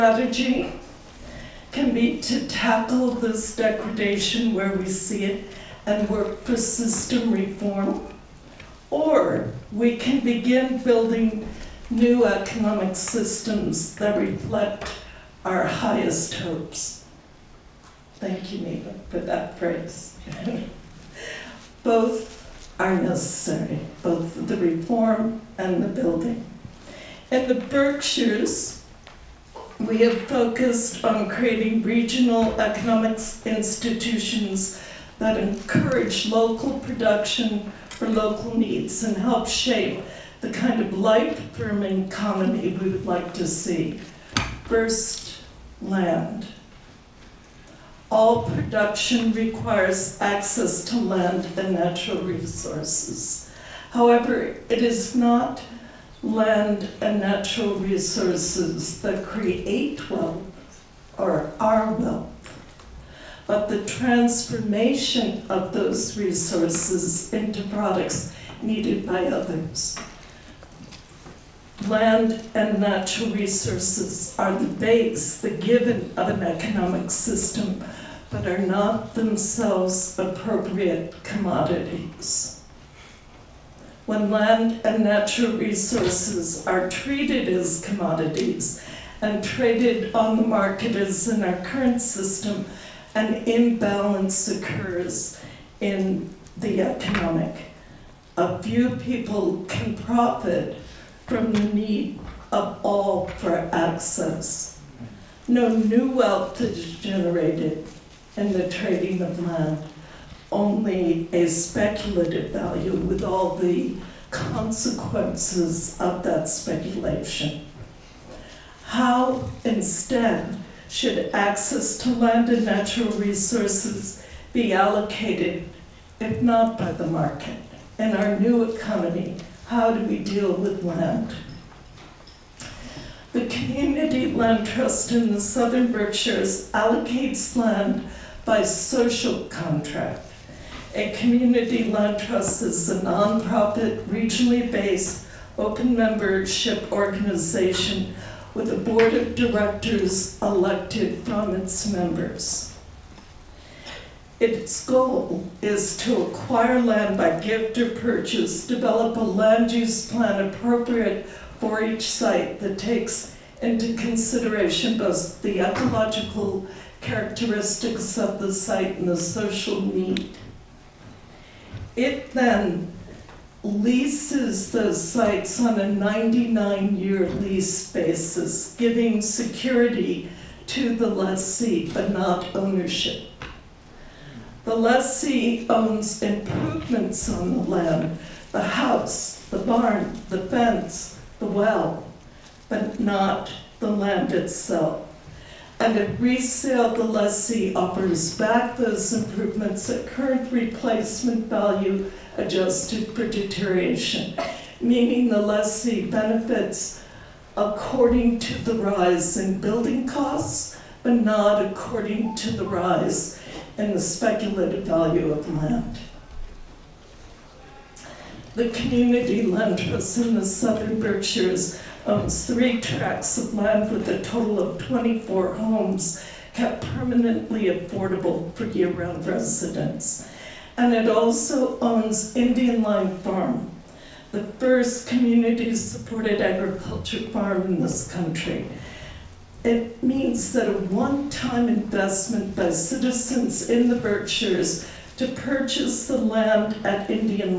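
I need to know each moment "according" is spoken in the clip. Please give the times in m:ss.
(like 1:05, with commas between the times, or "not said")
3:27, 3:31.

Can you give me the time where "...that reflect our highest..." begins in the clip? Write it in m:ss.
0:13.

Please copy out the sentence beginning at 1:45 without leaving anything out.
No new wealth is generated in the trading of land only a speculative value with all the consequences of that speculation.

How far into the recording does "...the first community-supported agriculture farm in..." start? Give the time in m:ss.
3:54.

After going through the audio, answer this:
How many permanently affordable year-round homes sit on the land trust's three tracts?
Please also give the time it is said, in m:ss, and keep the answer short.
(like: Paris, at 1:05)
24, at 3:44.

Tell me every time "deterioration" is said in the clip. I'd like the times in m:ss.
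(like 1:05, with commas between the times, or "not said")
3:23.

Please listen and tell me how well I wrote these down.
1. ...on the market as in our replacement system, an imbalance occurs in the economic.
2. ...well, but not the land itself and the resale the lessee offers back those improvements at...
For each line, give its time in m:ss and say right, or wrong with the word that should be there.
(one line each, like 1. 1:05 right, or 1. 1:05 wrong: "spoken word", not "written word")
1. 1:30 wrong: "current", not "replacement"
2. 3:11 right.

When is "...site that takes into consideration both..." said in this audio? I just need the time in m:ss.
2:42.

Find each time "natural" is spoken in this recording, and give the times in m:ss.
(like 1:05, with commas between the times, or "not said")
0:51, 0:57, 1:12, 1:25, 2:02.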